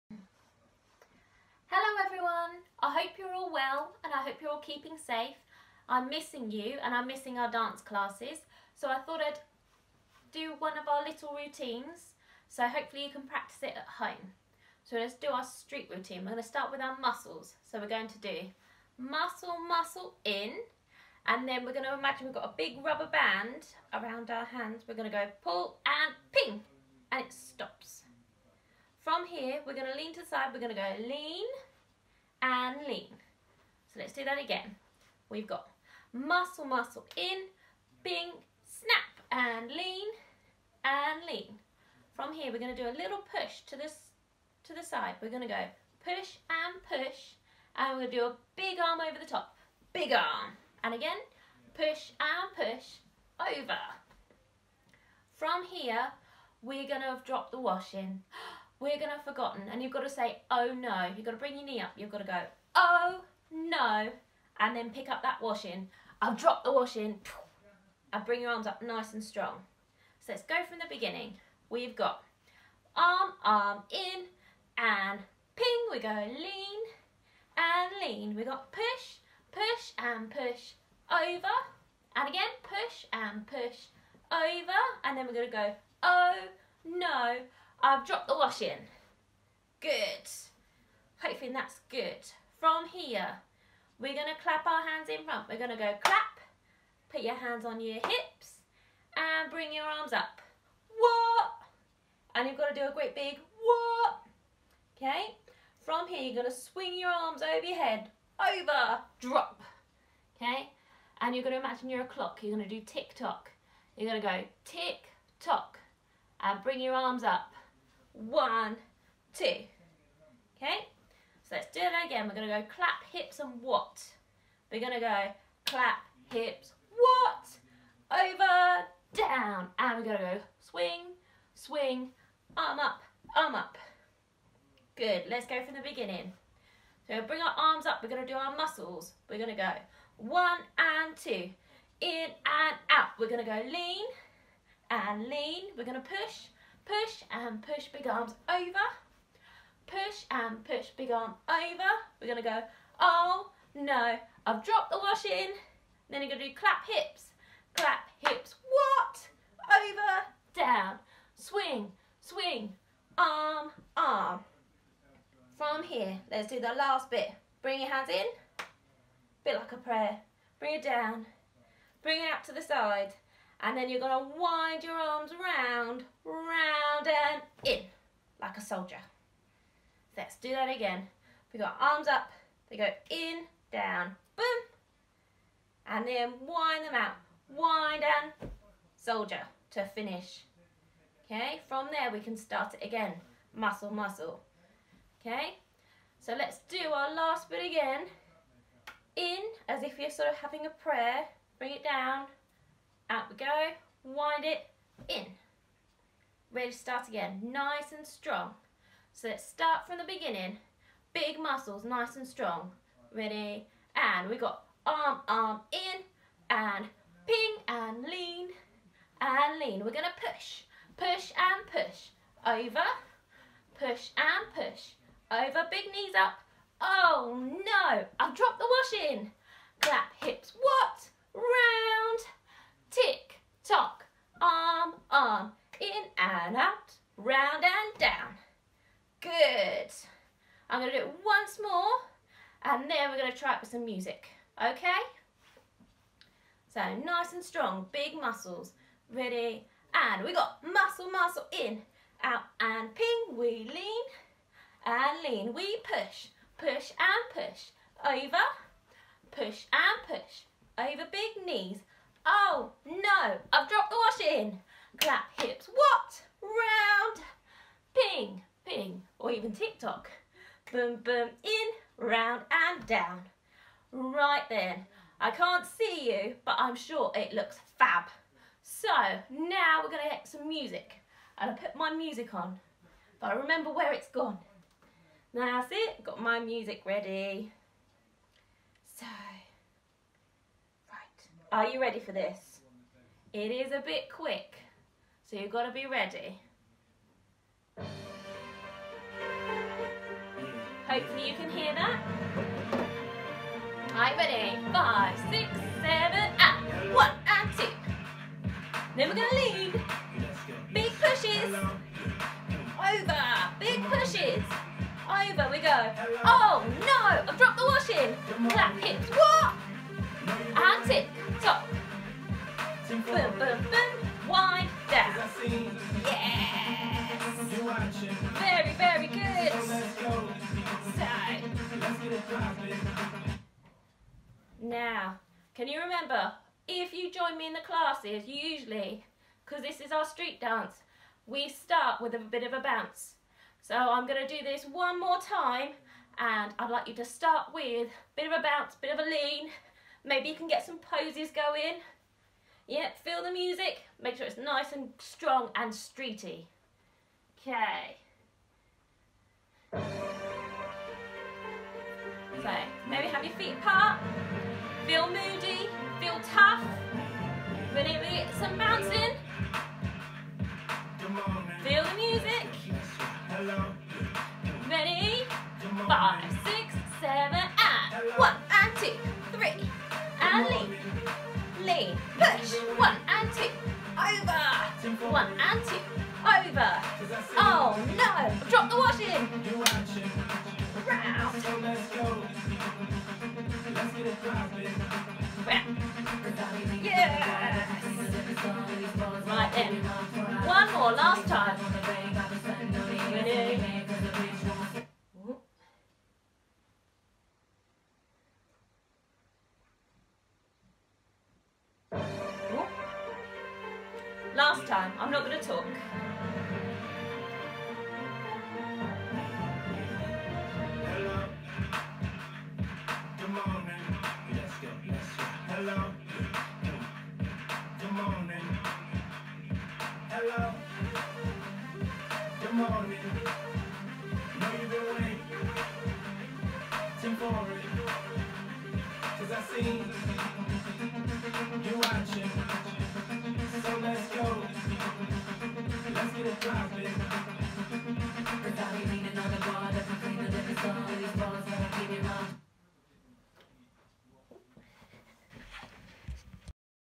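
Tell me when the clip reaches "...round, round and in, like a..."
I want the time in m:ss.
2:55.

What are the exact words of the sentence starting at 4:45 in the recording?
Now that's it, got my music ready.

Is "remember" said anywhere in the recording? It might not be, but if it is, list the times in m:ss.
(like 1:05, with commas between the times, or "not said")
4:43, 5:35.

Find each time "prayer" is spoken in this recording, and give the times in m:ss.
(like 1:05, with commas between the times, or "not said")
2:49, 3:20.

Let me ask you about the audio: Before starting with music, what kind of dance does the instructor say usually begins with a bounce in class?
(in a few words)
Street dance.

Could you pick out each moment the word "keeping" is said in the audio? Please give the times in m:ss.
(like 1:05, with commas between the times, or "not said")
0:04.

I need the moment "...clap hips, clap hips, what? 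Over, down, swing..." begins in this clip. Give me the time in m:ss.
2:36.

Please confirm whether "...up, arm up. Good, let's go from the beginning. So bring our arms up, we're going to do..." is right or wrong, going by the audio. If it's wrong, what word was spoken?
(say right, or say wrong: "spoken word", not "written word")
right.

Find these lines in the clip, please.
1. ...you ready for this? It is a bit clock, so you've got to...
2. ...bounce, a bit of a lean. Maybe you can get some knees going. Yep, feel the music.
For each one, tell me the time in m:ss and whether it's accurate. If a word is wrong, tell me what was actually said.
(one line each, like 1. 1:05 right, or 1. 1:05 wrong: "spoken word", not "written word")
1. 4:51 wrong: "quick", not "clock"
2. 5:48 wrong: "poses", not "knees".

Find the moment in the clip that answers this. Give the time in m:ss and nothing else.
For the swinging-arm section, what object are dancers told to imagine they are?
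1:51.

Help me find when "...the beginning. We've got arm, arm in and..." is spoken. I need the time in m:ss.
1:10.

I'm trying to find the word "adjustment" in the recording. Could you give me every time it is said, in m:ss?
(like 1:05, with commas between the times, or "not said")
not said.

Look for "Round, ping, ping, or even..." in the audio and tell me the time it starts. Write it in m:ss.
4:26.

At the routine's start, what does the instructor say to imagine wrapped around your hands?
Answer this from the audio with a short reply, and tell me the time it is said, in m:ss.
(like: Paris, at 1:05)
Big rubber band, at 0:22.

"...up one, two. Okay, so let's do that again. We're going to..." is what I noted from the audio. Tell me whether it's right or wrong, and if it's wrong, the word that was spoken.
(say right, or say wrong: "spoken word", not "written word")
right.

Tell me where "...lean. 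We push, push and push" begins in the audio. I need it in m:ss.
4:15.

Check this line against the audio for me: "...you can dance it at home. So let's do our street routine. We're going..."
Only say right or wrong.
wrong.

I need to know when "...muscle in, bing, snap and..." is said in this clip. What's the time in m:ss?
0:36.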